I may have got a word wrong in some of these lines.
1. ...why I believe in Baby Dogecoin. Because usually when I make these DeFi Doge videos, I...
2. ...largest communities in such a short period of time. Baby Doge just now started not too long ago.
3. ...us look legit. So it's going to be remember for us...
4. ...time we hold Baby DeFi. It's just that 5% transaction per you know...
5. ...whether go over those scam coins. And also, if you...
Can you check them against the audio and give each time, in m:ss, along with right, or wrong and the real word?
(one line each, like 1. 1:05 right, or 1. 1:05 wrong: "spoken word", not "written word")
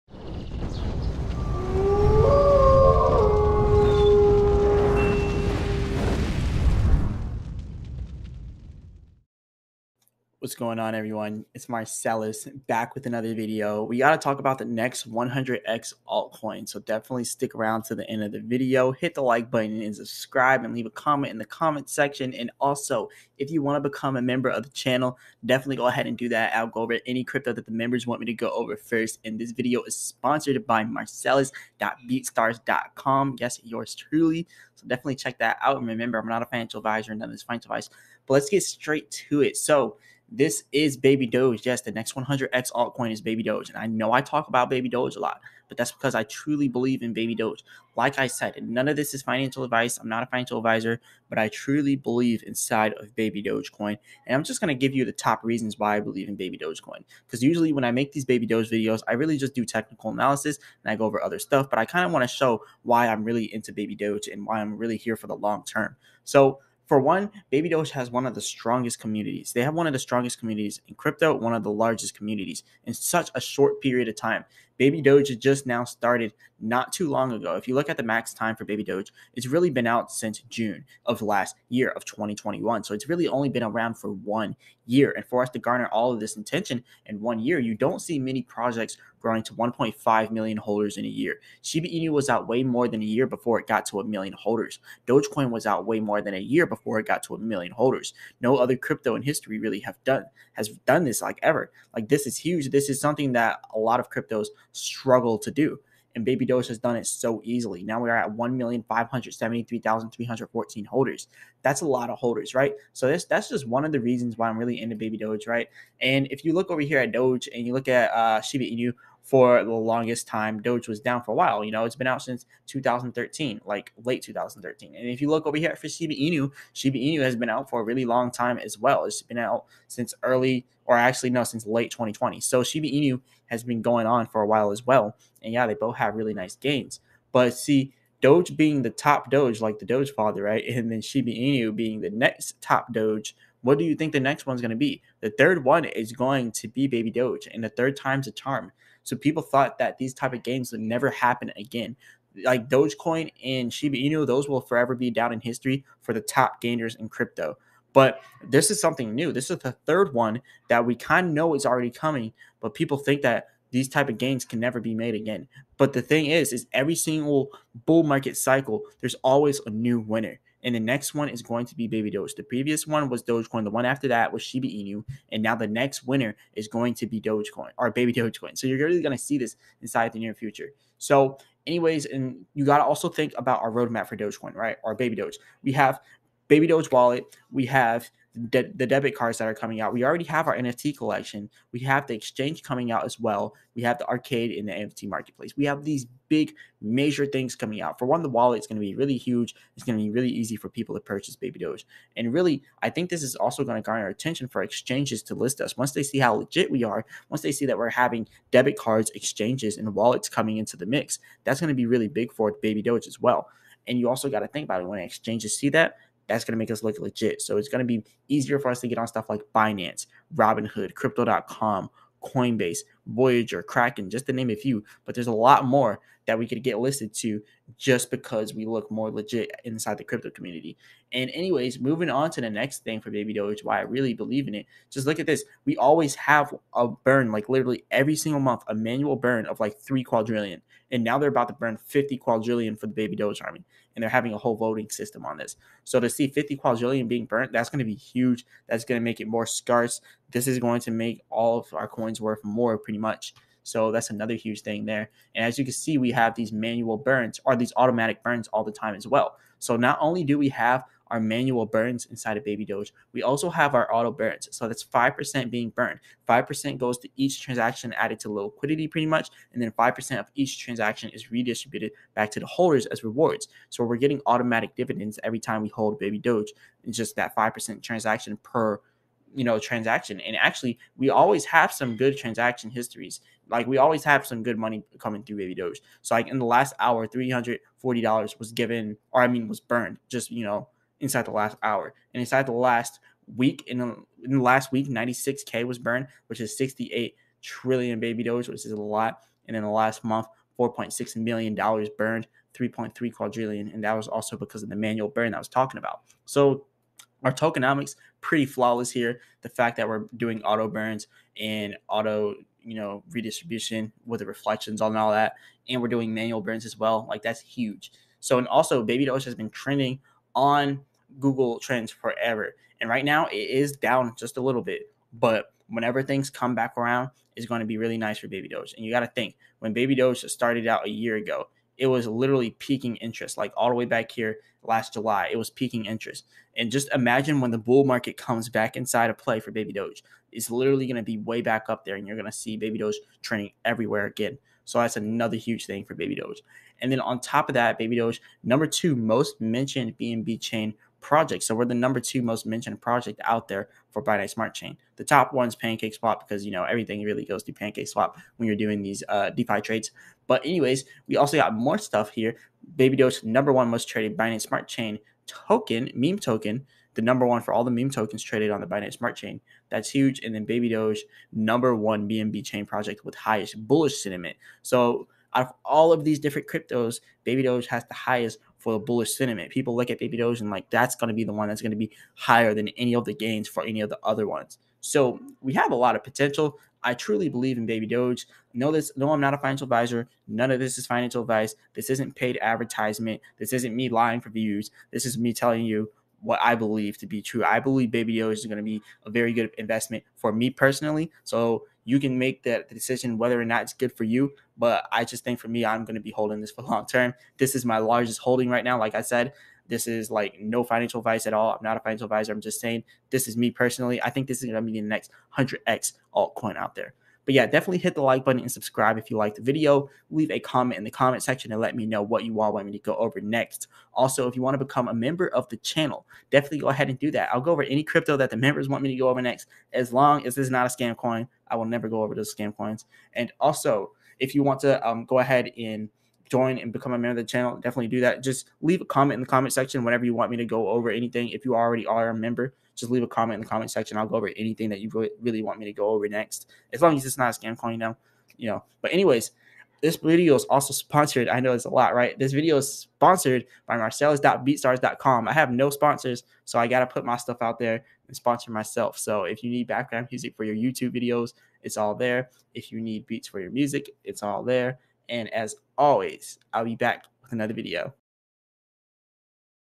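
1. 0:55 wrong: "Baby", not "DeFi"
2. 1:11 right
3. 3:36 wrong: "easier", not "remember"
4. 4:35 wrong: "Doge", not "DeFi"
5. 7:11 wrong: "never", not "whether".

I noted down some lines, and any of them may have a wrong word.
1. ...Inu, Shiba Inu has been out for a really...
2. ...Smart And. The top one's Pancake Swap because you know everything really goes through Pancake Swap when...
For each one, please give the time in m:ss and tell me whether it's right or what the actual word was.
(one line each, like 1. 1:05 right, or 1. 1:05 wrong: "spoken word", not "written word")
1. 2:06 right
2. 5:54 wrong: "Chain", not "And".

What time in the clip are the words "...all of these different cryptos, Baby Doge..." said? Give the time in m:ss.
6:15.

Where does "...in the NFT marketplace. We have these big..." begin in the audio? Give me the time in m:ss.
3:14.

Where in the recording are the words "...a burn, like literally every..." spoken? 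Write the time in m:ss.
3:56.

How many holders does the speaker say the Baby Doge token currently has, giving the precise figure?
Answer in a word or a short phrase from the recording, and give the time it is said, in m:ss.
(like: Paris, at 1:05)
1,573,314, at 1:48.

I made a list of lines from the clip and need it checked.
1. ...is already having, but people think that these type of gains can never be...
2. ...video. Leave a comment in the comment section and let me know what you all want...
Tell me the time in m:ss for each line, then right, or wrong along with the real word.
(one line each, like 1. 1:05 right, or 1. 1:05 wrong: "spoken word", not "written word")
1. 2:41 wrong: "coming", not "having"
2. 6:59 right.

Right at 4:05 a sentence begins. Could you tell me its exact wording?
So to see 50 quadrillion being burnt, that's going to be huge.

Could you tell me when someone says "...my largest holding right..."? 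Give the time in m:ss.
6:47.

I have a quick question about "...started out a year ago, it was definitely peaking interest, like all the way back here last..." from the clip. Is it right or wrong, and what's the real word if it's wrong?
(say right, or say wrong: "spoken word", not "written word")
wrong: "literally", not "definitely".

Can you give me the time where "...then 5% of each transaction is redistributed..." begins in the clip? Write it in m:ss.
4:29.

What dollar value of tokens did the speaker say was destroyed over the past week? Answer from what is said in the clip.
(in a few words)
96K.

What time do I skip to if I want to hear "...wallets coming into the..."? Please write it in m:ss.
3:29.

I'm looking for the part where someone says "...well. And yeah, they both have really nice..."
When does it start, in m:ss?
2:14.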